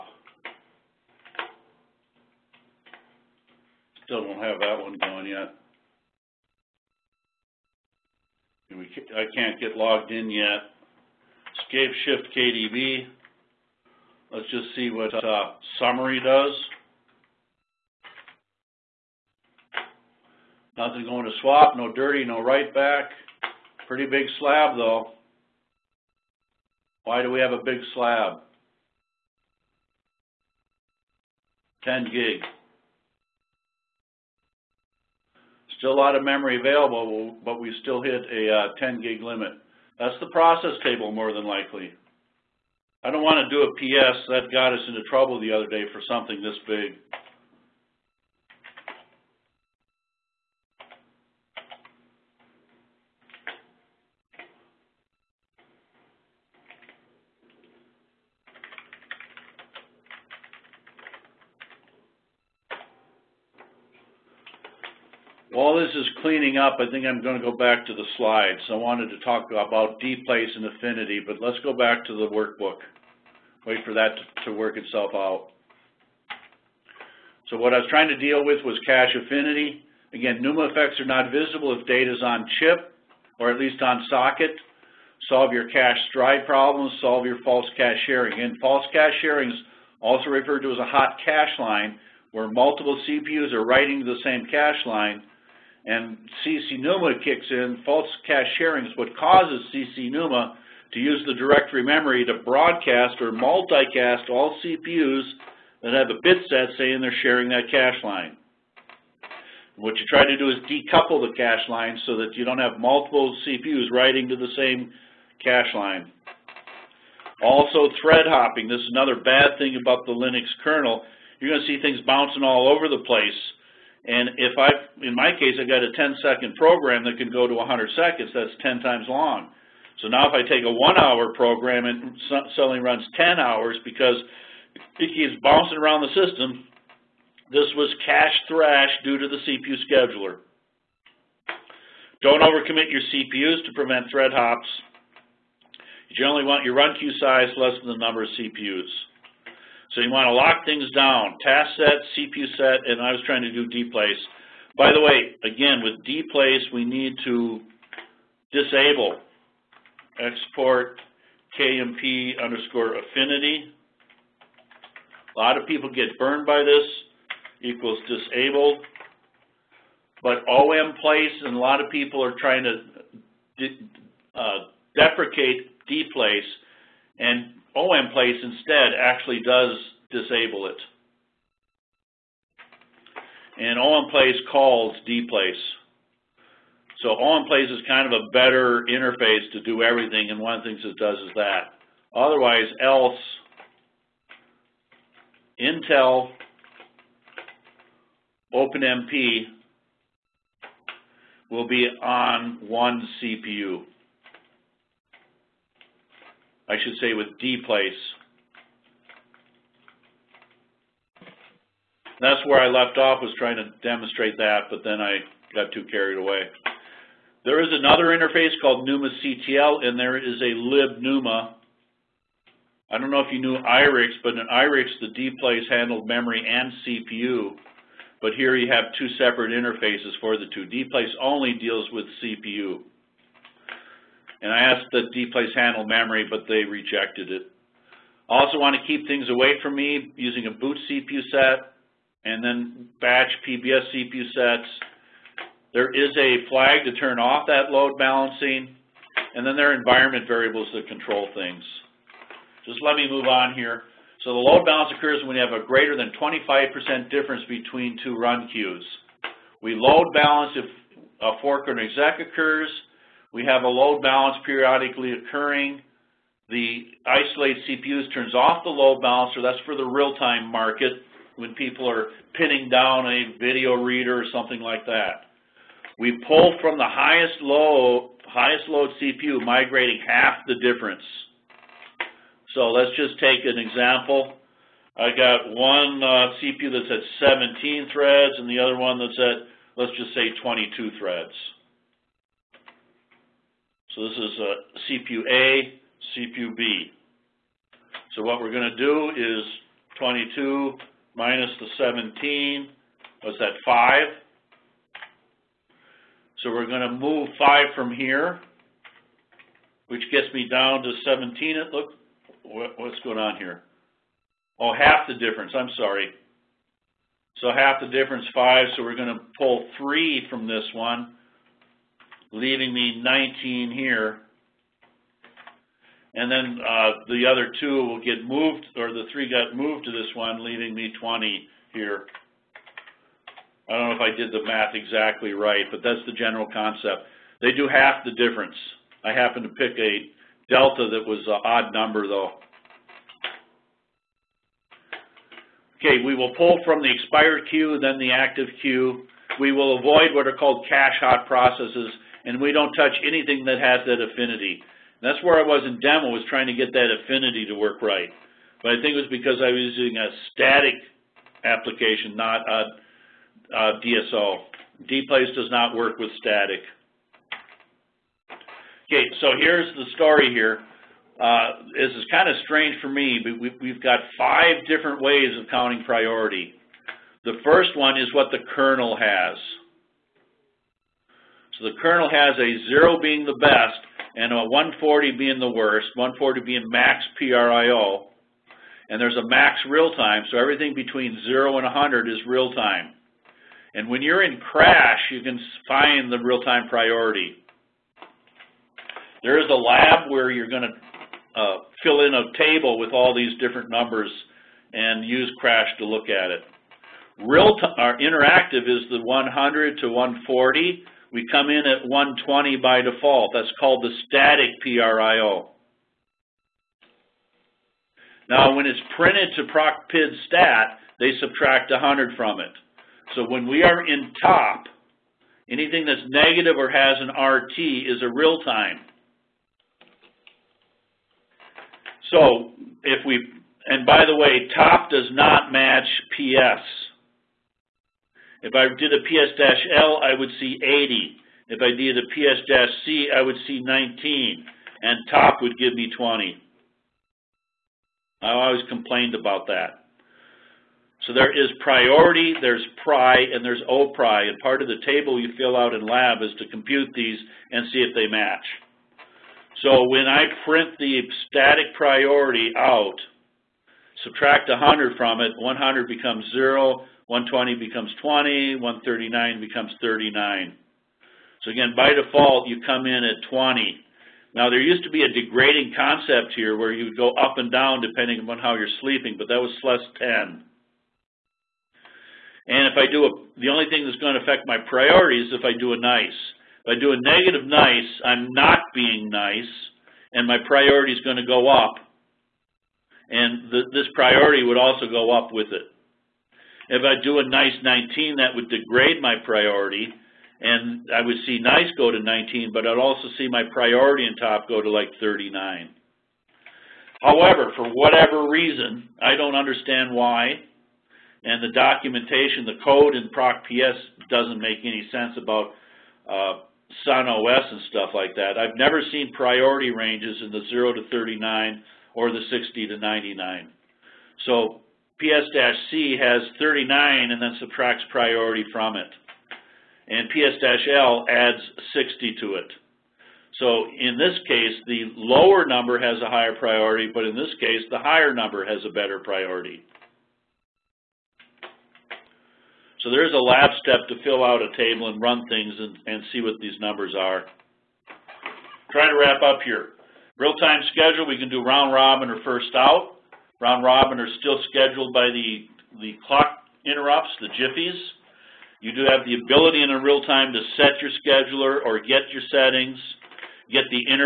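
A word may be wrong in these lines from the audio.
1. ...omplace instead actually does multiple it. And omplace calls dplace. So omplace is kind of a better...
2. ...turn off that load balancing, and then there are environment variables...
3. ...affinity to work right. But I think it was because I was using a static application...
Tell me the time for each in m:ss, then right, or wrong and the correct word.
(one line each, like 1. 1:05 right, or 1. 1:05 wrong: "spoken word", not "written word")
1. 2:57 wrong: "disable", not "multiple"
2. 4:06 right
3. 5:57 right.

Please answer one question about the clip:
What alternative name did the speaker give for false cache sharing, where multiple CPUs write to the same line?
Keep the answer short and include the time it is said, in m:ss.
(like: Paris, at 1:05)
hot cache line, at 1:30.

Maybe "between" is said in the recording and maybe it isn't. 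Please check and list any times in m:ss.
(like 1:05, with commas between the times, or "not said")
4:17, 6:30.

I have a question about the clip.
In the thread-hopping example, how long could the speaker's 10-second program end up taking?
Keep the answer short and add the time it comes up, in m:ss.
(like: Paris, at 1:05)
100 seconds, at 2:07.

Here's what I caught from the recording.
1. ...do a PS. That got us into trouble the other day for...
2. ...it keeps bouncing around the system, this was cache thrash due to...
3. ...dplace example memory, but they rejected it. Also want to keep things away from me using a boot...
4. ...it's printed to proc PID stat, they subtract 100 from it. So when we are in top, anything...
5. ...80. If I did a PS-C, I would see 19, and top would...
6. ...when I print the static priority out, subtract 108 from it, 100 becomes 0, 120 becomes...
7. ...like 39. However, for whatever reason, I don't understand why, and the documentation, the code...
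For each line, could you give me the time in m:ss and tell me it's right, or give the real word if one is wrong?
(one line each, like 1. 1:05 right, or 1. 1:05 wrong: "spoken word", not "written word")
1. 0:43 right
2. 2:14 right
3. 3:55 wrong: "handle", not "example"
4. 6:58 right
5. 7:20 right
6. 7:39 wrong: "100", not "108"
7. 8:24 right.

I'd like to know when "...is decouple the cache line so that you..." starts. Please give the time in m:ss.
1:50.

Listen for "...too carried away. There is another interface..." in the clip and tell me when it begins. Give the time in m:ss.
3:35.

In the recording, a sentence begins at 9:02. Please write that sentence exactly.
So there's a lab step to fill out a table and run things and, and see what these numbers are.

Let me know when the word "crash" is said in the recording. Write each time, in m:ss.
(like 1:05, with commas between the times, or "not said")
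6:34, 6:45.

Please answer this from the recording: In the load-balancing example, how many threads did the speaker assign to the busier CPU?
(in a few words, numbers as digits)
22.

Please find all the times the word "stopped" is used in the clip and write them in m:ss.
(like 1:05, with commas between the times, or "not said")
not said.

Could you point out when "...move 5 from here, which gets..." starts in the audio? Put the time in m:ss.
5:06.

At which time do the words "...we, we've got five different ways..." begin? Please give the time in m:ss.
6:13.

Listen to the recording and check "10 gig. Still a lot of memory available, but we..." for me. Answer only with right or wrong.
right.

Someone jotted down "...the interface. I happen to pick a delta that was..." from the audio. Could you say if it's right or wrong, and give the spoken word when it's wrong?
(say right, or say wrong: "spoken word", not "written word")
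wrong: "difference", not "interface".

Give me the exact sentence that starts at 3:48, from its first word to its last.
But here you have two separate interfaces for the two.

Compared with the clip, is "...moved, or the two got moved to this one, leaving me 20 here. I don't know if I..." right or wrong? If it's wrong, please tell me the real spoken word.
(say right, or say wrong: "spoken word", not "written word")
wrong: "three", not "two".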